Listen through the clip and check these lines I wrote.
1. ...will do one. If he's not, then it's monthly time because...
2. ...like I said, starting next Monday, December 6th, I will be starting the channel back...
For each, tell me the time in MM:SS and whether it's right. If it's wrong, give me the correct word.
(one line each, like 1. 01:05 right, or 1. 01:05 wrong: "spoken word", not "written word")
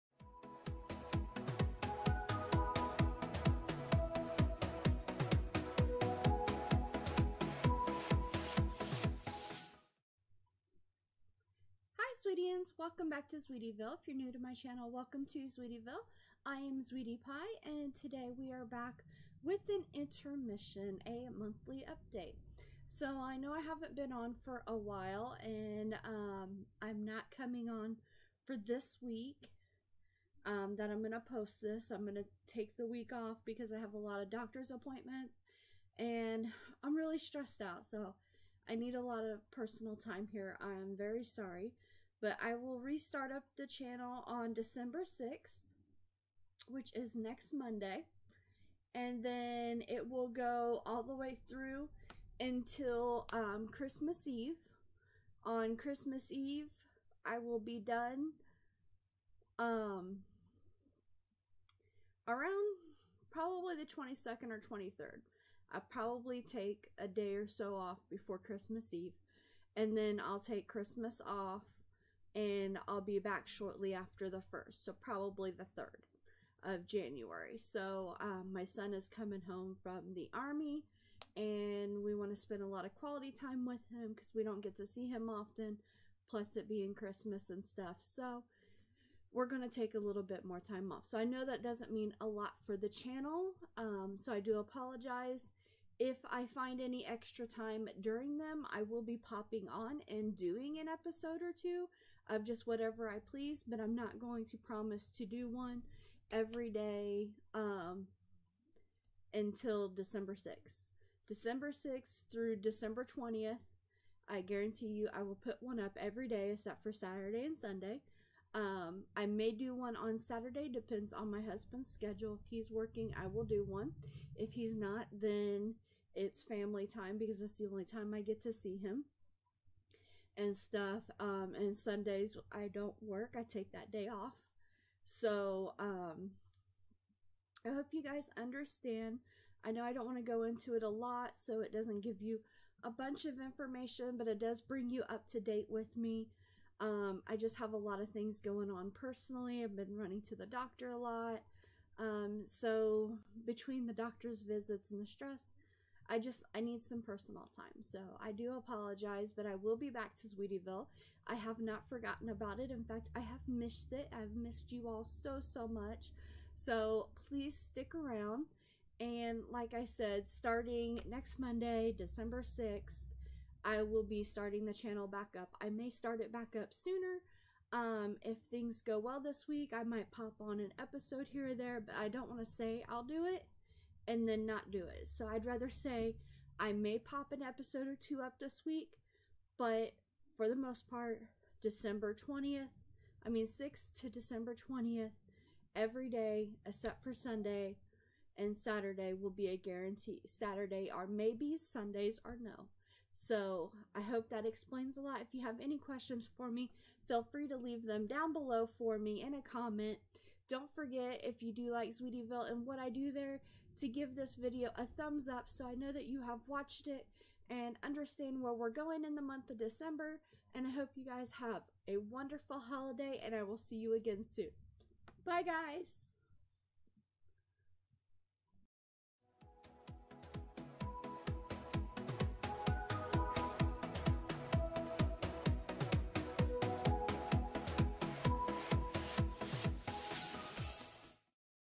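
1. 02:03 wrong: "family", not "monthly"
2. 02:49 right.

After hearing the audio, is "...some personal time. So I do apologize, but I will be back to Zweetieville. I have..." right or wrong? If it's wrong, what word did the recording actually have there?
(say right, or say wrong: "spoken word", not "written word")
right.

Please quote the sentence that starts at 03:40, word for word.
And I hope you guys have a wonderful holiday, and I will see you again soon.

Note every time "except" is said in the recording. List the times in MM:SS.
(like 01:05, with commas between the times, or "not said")
01:56, 03:16.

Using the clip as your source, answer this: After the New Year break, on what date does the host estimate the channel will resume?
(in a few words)
January 3.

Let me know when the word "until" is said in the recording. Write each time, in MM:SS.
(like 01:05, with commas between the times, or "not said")
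00:52, 01:49.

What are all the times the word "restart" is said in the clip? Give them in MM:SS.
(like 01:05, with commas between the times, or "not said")
00:42.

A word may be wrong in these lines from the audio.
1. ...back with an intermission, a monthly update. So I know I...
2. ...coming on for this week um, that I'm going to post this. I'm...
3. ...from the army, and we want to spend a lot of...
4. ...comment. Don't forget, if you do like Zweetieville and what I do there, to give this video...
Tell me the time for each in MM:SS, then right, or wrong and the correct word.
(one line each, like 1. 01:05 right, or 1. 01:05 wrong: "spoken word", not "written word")
1. 00:18 right
2. 00:27 right
3. 01:19 right
4. 03:29 right.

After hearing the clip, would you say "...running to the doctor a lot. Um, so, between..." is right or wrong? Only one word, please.
right.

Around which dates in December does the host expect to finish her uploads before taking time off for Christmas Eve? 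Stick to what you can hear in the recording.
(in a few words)
22nd or 23rd.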